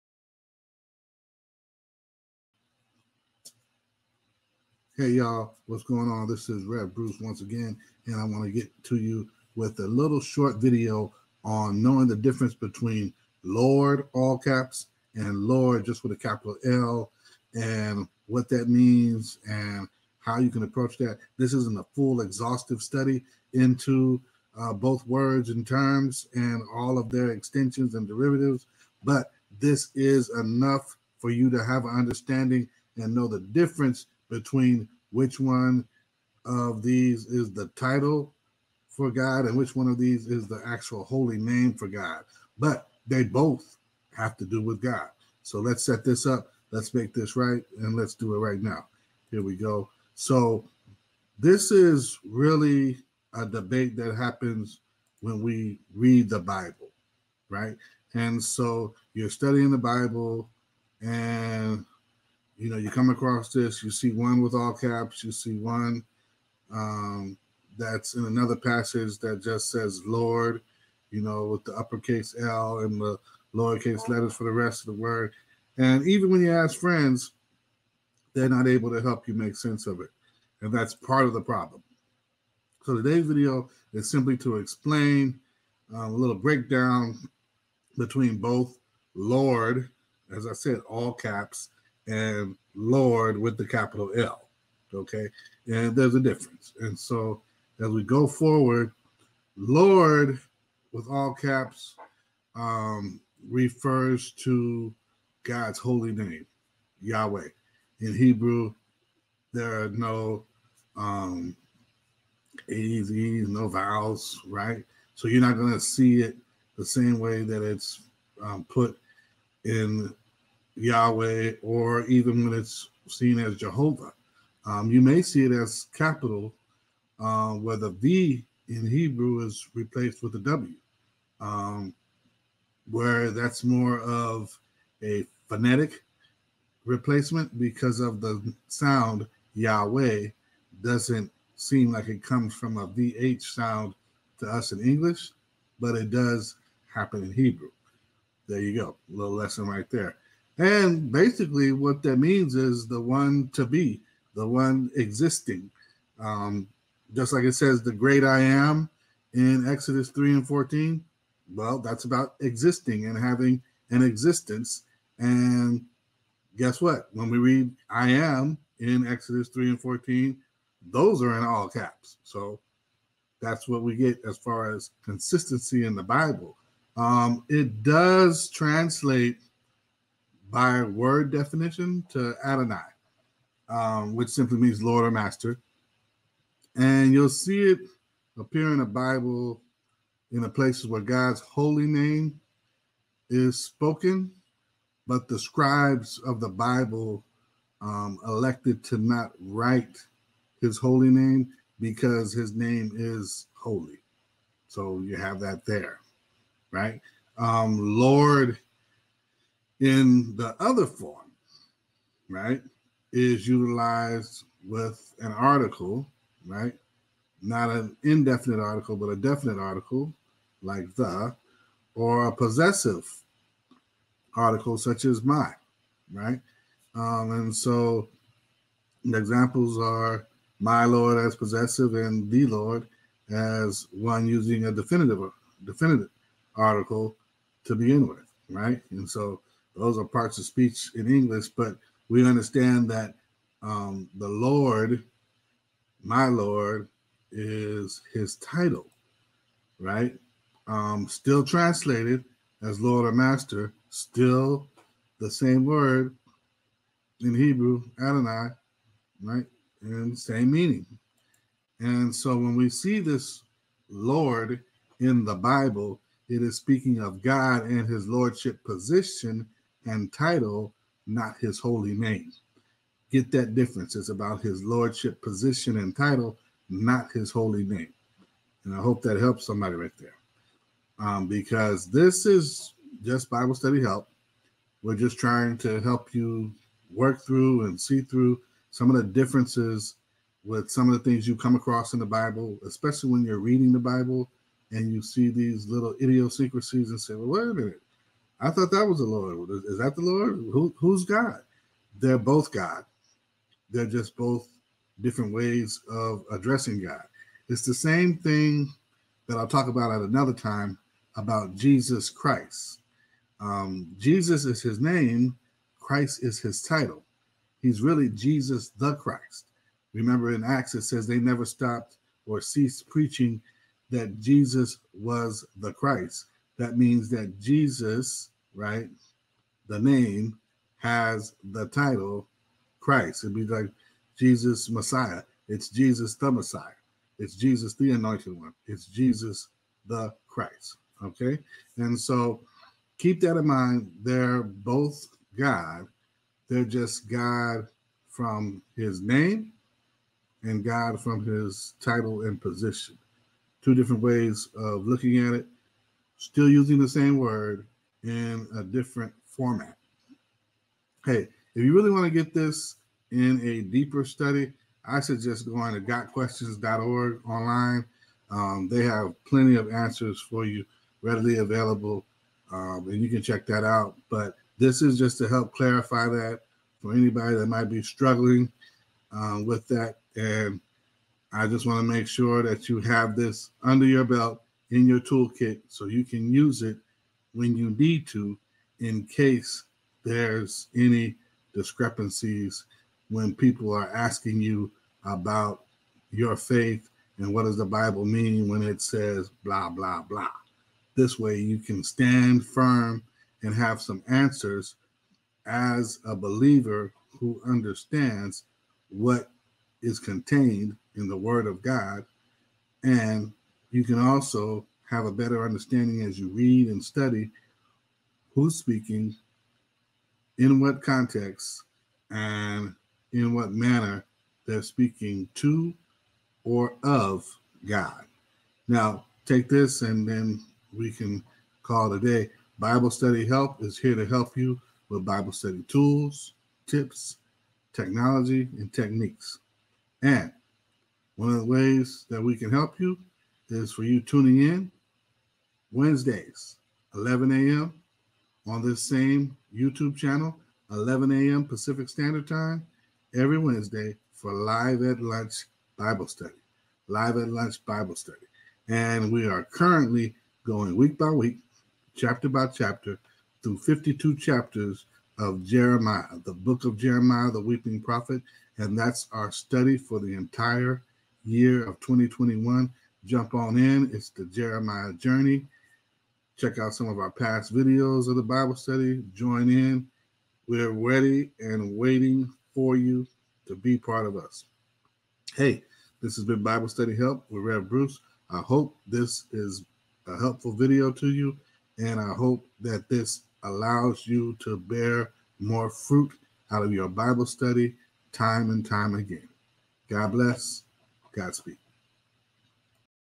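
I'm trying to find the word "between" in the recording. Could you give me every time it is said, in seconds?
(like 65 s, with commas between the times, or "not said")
12 s, 34 s, 87 s.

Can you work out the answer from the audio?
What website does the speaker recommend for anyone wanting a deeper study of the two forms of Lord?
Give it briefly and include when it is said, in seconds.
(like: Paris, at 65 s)
gotquestions.org, at 365 s.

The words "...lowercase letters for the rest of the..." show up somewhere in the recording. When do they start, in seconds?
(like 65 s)
73 s.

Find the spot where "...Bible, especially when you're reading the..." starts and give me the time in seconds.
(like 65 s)
292 s.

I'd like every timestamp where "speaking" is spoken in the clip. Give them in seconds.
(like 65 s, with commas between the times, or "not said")
266 s, 418 s, 424 s.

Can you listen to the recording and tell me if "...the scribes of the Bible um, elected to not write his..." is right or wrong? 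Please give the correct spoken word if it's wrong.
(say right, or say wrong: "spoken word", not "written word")
right.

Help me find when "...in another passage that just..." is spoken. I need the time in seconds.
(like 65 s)
68 s.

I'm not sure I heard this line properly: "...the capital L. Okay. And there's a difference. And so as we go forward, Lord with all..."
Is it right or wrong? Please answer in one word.
right.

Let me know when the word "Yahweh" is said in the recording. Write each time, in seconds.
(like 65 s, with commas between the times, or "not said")
107 s, 120 s, 139 s.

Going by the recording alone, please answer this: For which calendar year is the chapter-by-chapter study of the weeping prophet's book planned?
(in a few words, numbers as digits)
2021.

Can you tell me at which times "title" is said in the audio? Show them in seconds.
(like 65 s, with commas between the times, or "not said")
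37 s, 248 s, 270 s, 275 s, 316 s, 331 s, 351 s.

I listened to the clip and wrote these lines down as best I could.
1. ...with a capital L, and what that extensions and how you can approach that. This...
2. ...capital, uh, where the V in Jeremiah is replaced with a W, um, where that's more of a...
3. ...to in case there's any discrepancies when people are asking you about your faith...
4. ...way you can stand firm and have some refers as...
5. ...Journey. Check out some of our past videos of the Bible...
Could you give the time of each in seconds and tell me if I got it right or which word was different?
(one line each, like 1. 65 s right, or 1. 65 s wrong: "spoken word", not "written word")
1. 16 s wrong: "means", not "extensions"
2. 125 s wrong: "Hebrew", not "Jeremiah"
3. 388 s right
4. 401 s wrong: "answers", not "refers"
5. 474 s right.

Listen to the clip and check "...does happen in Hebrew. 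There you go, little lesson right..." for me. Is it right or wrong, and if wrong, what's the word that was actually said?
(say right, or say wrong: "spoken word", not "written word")
right.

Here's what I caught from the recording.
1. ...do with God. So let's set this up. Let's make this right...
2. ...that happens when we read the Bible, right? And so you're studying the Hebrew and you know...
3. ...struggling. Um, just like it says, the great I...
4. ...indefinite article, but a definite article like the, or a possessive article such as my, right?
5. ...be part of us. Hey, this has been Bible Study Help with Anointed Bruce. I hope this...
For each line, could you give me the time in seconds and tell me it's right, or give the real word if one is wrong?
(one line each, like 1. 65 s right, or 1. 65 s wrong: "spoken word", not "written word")
1. 44 s right
2. 53 s wrong: "Bible", not "Hebrew"
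3. 154 s wrong: "existing", not "struggling"
4. 218 s right
5. 483 s wrong: "Rev", not "Anointed".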